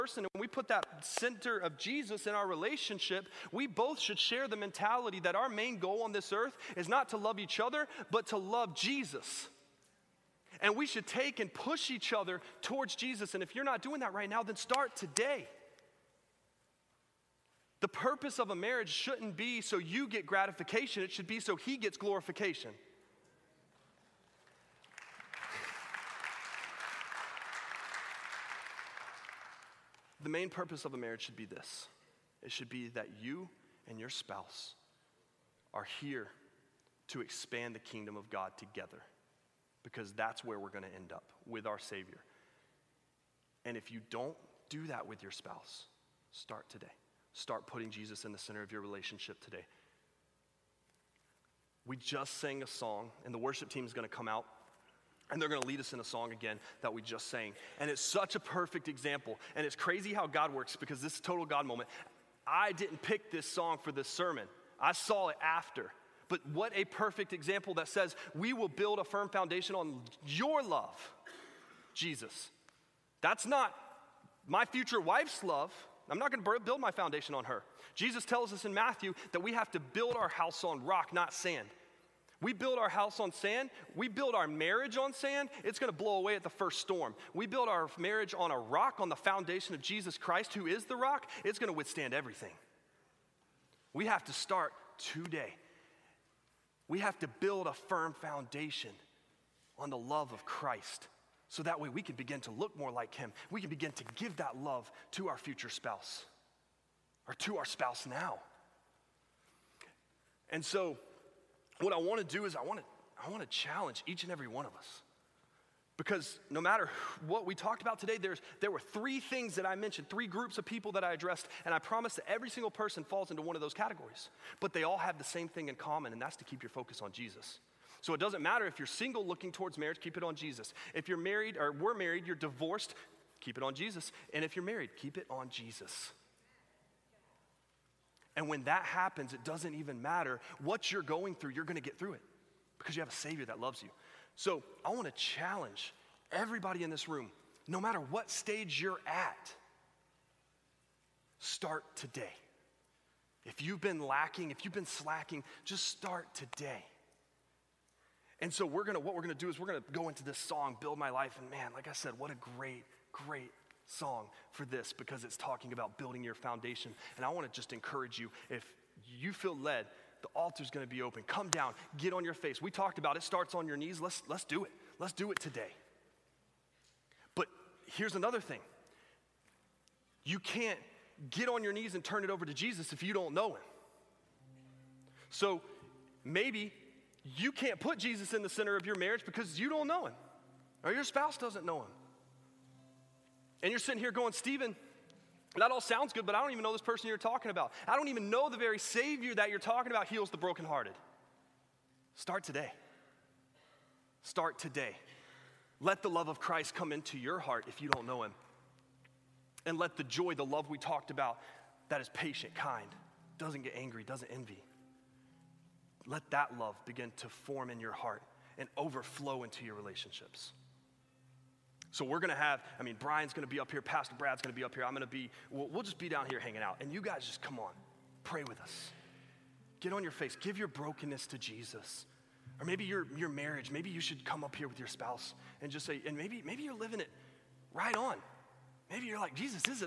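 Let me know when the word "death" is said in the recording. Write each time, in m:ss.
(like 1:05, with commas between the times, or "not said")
not said.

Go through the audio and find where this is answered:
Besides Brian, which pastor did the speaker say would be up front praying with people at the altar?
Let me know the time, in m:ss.
3:43.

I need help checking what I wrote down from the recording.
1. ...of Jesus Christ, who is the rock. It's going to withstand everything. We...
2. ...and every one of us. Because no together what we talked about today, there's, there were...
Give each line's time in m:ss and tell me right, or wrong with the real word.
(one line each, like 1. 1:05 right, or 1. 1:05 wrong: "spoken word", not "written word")
1. 1:29 right
2. 1:54 wrong: "matter", not "together".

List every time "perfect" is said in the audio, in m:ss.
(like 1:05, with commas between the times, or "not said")
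0:58, 1:06.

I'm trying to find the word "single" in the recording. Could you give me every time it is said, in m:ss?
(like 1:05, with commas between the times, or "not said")
2:02, 2:08.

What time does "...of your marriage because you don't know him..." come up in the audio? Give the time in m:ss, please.
3:08.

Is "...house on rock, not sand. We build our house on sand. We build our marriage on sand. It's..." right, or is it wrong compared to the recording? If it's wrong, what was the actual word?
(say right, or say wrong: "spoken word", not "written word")
right.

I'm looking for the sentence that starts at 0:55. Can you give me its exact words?
And they're going to lead us in a song again that we just sang.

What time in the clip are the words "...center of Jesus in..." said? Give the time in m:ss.
0:01.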